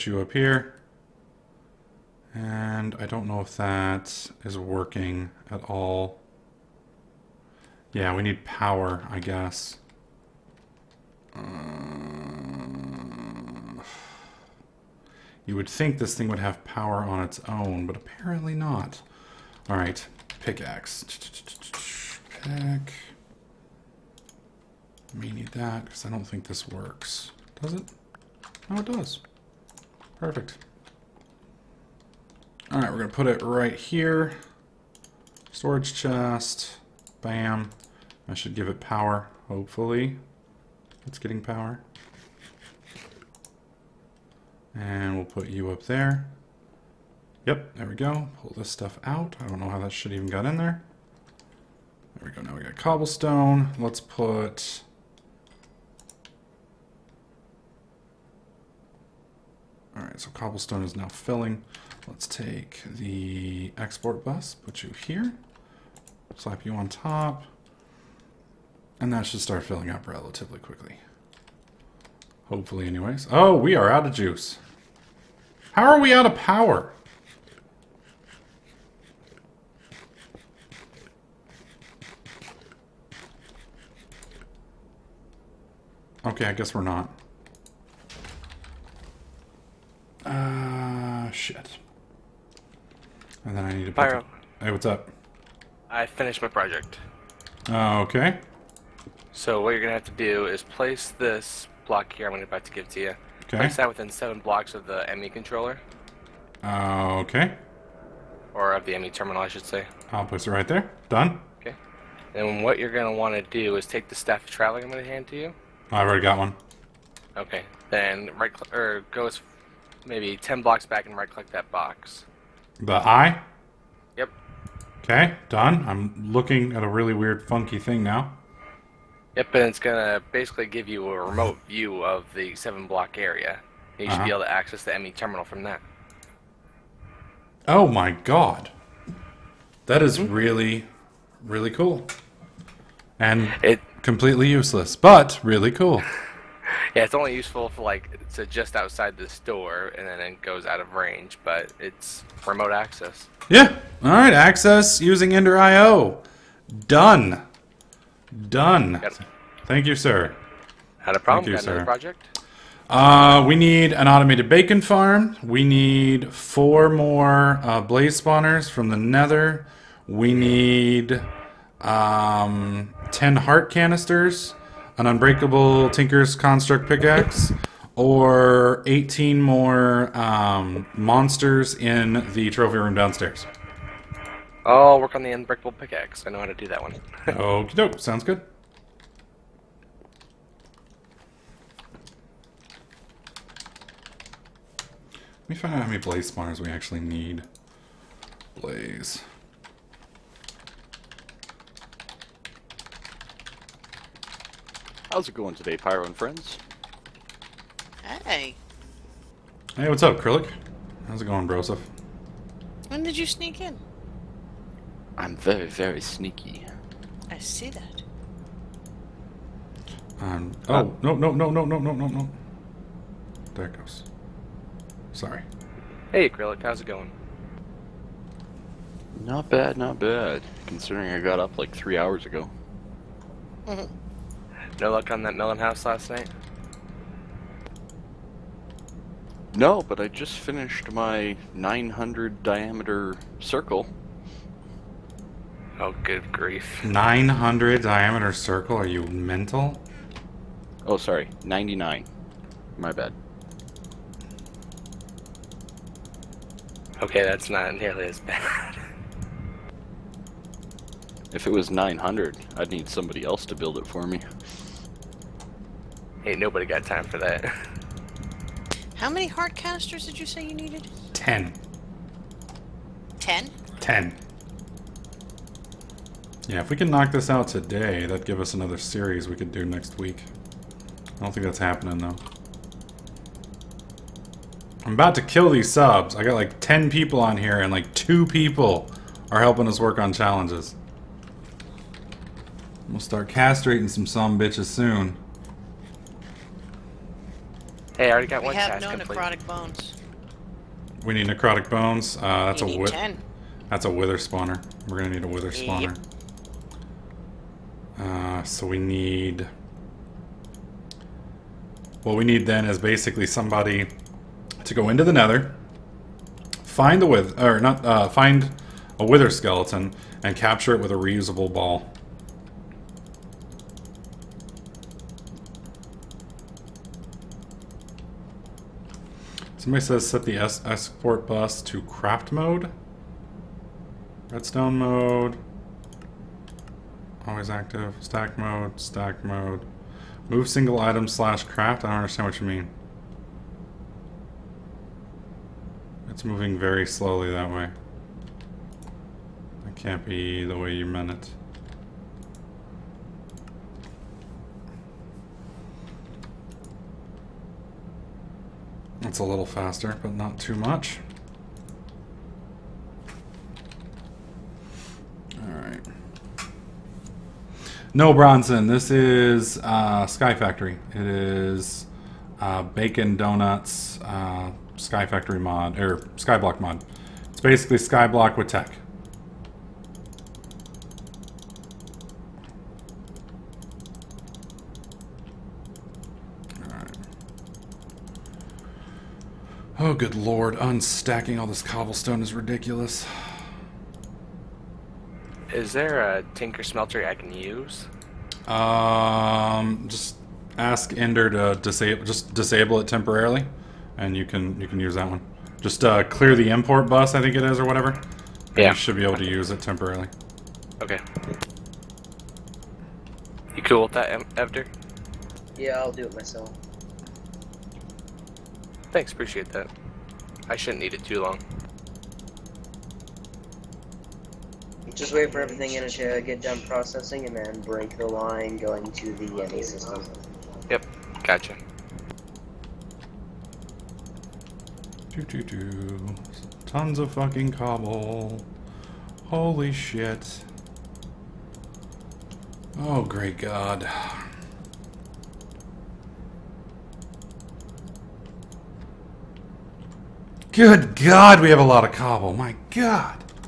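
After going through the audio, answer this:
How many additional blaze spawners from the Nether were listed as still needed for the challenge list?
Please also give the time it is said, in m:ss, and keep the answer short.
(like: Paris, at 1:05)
4, at 2:46.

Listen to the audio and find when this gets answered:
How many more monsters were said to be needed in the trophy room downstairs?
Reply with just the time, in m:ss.
2:58.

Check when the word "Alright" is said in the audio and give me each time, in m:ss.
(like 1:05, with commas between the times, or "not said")
0:59, 2:34.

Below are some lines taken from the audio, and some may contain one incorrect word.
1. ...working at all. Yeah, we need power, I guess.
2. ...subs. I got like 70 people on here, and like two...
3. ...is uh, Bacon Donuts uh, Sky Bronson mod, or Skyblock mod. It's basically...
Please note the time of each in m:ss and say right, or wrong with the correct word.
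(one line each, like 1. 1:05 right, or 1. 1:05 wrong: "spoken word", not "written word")
1. 0:04 right
2. 4:45 wrong: "10", not "70"
3. 6:11 wrong: "Factory", not "Bronson".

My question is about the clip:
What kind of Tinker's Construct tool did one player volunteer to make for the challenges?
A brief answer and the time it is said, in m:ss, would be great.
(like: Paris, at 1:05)
unbreakable pickaxe, at 3:05.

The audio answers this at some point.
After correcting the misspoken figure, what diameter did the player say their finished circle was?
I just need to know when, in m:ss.
4:11.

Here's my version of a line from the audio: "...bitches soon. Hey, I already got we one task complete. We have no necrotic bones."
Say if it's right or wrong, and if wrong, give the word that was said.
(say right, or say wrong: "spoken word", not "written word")
right.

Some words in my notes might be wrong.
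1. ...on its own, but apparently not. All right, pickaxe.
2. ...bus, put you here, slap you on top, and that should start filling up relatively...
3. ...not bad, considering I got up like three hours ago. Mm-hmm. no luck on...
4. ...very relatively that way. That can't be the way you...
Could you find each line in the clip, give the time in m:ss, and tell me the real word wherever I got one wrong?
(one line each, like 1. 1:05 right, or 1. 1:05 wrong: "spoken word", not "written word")
1. 0:17 right
2. 1:04 right
3. 3:49 right
4. 5:46 wrong: "slowly", not "relatively".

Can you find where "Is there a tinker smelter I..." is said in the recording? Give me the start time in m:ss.
6:35.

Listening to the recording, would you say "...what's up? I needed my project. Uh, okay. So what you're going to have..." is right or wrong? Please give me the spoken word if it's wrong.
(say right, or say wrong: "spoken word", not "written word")
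wrong: "finished", not "needed".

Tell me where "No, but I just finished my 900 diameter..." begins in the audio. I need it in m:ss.
3:59.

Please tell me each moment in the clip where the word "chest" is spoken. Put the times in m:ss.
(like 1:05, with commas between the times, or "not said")
0:35.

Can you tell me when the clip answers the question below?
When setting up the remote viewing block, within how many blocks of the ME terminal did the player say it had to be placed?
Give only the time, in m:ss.
1:44.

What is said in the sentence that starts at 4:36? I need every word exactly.
Yeah, if we can knock this out today, that'd give us another series we could do next week.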